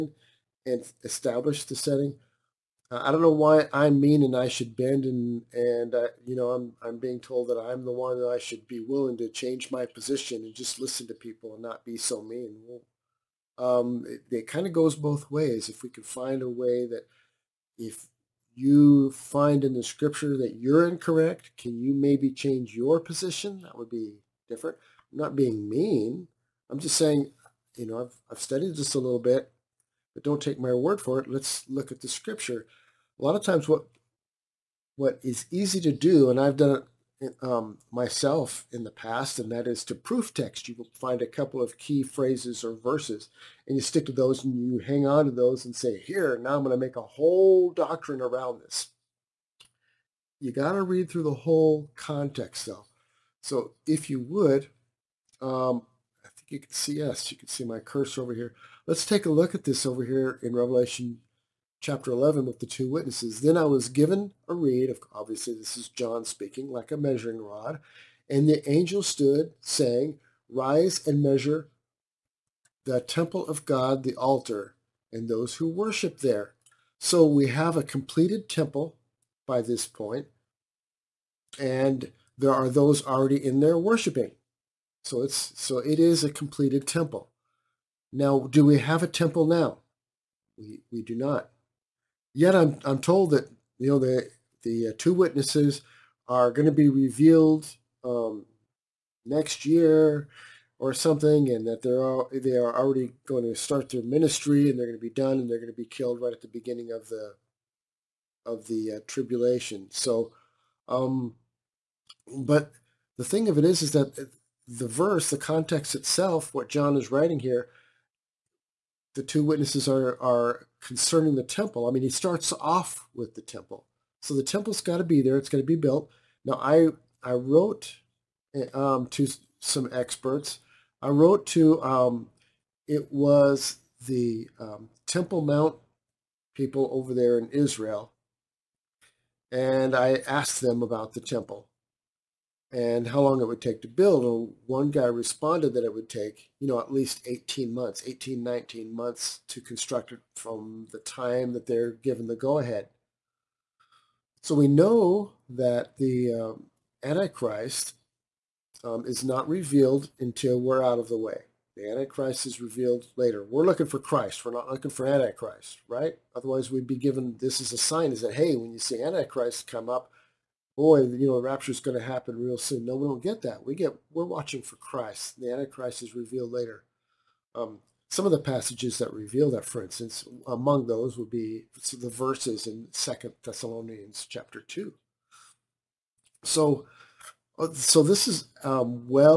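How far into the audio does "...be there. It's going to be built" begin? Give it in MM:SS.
02:05.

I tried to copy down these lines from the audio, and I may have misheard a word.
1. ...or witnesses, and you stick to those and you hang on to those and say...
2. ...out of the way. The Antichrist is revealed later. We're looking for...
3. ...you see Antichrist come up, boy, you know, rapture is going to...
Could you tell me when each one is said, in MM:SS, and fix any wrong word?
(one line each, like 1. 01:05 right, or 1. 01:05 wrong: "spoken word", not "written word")
1. 00:42 wrong: "verses", not "witnesses"
2. 02:40 right
3. 02:48 right.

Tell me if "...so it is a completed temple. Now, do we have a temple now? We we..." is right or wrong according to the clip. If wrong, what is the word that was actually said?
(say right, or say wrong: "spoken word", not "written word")
right.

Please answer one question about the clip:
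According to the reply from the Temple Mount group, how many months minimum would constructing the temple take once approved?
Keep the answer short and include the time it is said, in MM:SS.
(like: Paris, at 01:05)
18 months, at 02:27.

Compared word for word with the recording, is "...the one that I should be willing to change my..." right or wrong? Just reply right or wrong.
right.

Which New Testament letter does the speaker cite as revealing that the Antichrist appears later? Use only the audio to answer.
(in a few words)
Second Thessalonians.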